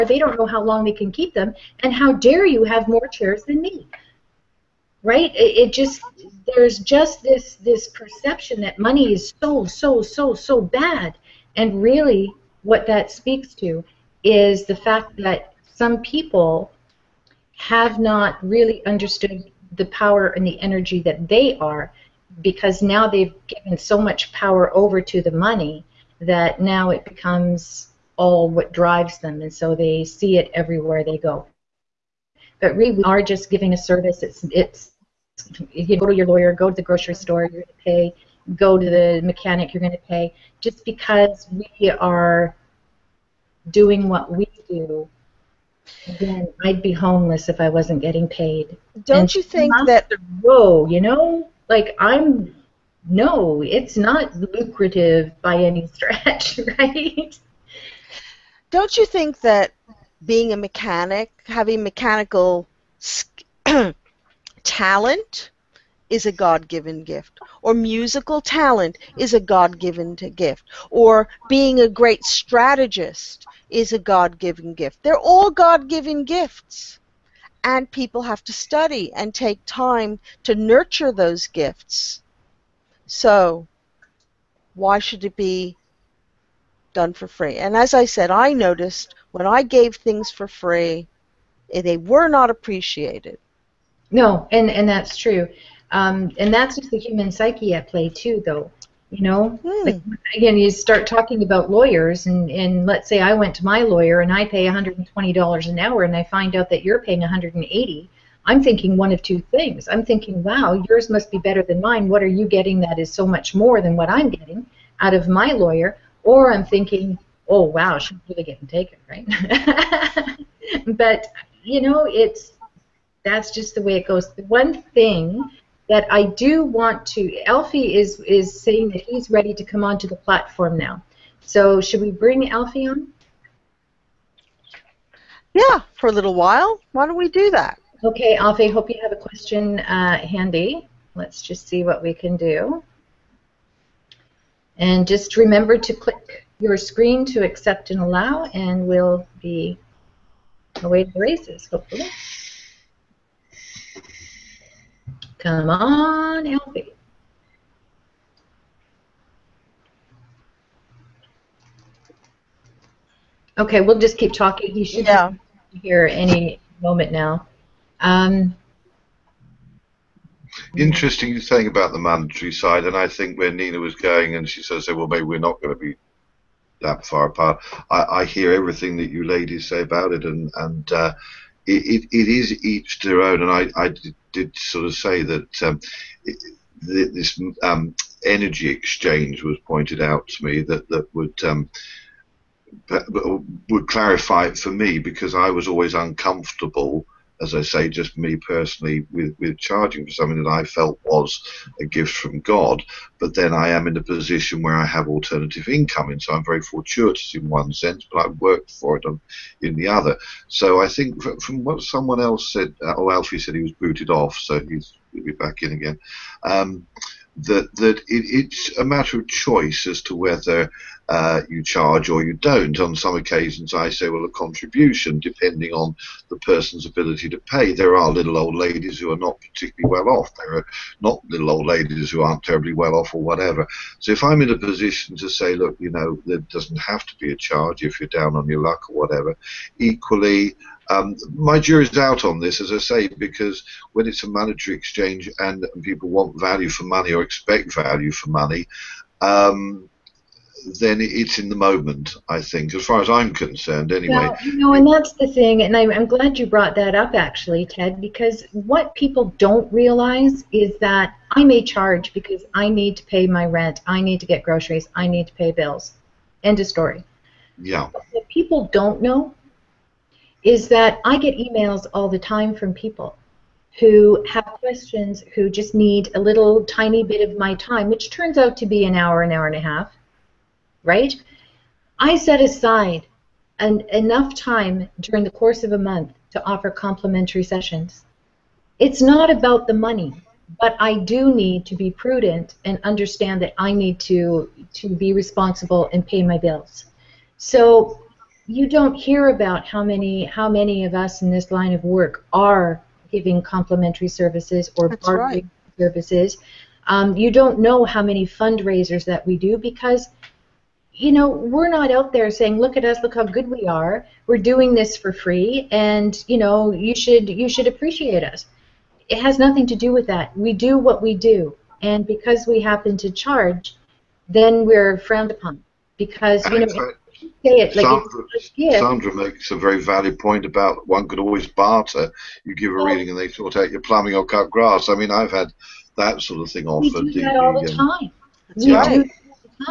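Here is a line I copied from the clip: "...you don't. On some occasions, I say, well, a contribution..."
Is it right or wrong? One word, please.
right.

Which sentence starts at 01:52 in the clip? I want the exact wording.
What are you getting that is so much more than what I'm getting out of my lawyer?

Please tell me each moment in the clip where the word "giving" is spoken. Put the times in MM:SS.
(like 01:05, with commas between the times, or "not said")
00:33, 05:03.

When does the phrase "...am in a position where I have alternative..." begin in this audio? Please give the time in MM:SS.
03:23.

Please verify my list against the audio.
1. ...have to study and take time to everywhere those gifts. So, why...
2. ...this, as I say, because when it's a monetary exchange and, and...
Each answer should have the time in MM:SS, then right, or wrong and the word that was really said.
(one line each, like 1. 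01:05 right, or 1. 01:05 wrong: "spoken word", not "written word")
1. 01:18 wrong: "nurture", not "everywhere"
2. 04:02 right.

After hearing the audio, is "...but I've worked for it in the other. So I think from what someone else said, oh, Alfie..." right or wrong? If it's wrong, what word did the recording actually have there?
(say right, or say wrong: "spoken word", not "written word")
right.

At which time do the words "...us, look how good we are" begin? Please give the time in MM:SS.
05:12.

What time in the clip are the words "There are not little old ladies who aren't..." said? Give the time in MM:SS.
03:50.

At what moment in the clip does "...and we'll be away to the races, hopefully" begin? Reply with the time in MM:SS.
02:28.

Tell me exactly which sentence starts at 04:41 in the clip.
I set aside an, enough time during the course of a month to offer complimentary sessions.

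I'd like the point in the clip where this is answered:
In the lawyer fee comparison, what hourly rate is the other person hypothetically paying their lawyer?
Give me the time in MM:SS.
01:47.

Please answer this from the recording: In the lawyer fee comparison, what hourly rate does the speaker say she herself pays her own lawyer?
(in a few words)
$120.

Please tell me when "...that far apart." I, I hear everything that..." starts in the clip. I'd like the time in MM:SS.
02:56.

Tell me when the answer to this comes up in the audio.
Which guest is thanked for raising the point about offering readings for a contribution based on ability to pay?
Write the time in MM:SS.
04:17.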